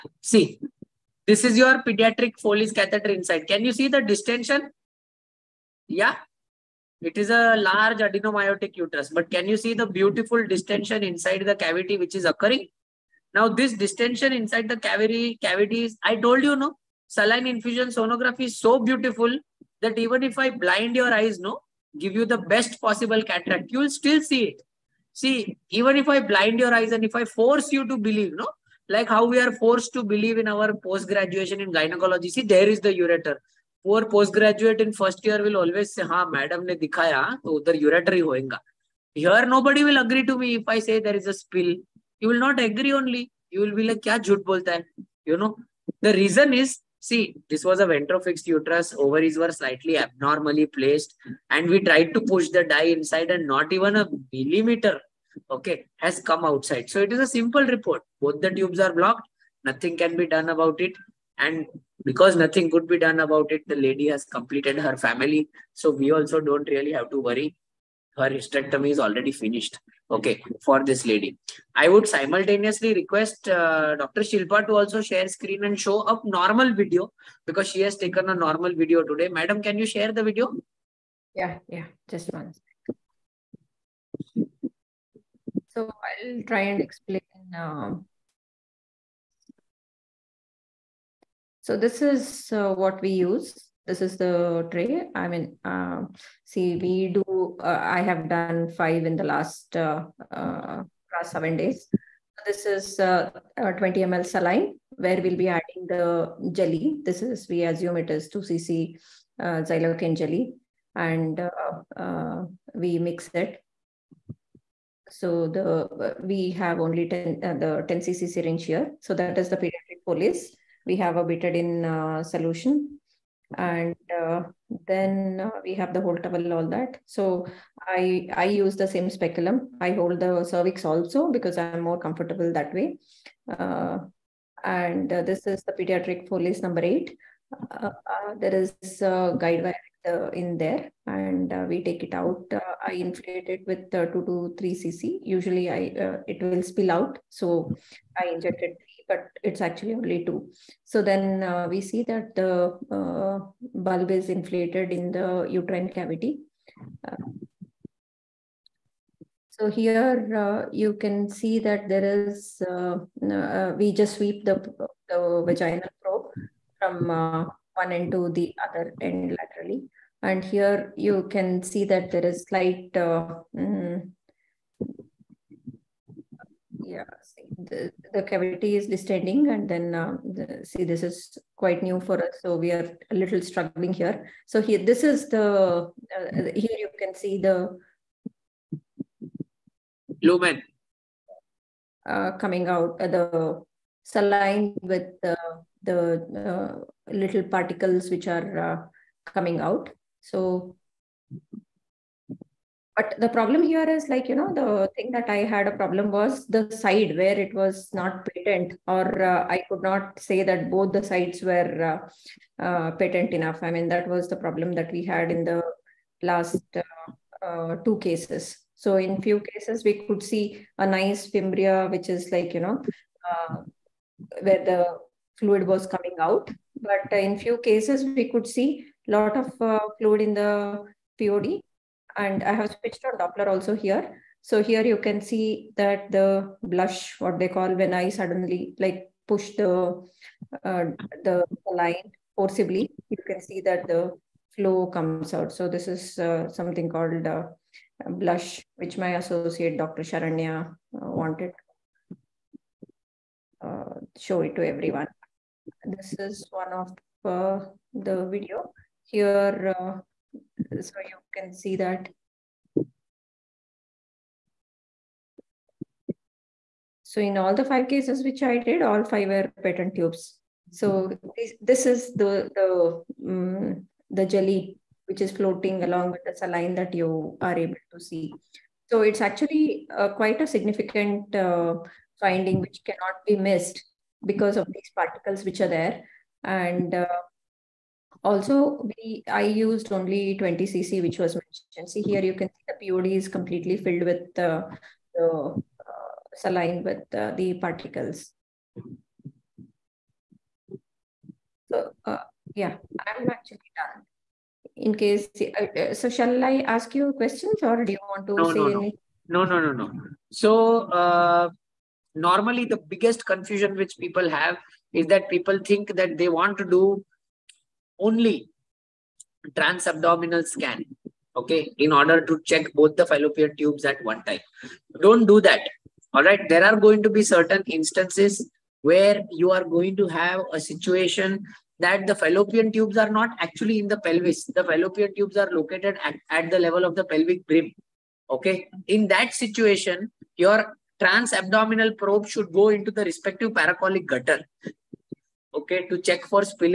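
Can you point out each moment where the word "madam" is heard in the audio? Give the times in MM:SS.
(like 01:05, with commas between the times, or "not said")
00:36, 01:19.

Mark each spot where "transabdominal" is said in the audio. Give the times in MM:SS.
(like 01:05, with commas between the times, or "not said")
05:19, 05:41.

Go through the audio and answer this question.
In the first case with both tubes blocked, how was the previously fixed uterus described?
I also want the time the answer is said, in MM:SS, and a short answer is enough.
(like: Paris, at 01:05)
ventrofixed, at 00:47.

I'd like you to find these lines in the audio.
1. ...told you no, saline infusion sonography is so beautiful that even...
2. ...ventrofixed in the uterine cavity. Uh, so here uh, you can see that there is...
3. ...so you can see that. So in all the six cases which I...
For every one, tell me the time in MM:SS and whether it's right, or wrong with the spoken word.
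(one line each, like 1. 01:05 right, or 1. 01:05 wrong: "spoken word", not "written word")
1. 00:16 right
2. 02:34 wrong: "inflated", not "ventrofixed"
3. 04:20 wrong: "five", not "six".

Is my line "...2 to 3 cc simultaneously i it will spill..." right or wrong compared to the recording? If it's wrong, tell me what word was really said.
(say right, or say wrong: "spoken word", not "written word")
wrong: "usually", not "simultaneously".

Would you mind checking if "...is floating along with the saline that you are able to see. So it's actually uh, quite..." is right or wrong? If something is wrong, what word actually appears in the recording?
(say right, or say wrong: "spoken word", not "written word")
right.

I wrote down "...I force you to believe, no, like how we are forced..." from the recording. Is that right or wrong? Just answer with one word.
right.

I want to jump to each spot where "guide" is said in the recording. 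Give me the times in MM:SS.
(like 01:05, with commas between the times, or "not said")
02:19.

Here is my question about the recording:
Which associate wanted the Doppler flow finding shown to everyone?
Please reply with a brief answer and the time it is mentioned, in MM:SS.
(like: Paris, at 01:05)
Dr. Sharanya, at 04:09.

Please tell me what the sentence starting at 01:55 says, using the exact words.
So the we have only 10, the 10 cc syringe here.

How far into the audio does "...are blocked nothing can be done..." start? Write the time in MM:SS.
00:58.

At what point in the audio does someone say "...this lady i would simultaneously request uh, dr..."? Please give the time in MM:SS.
01:10.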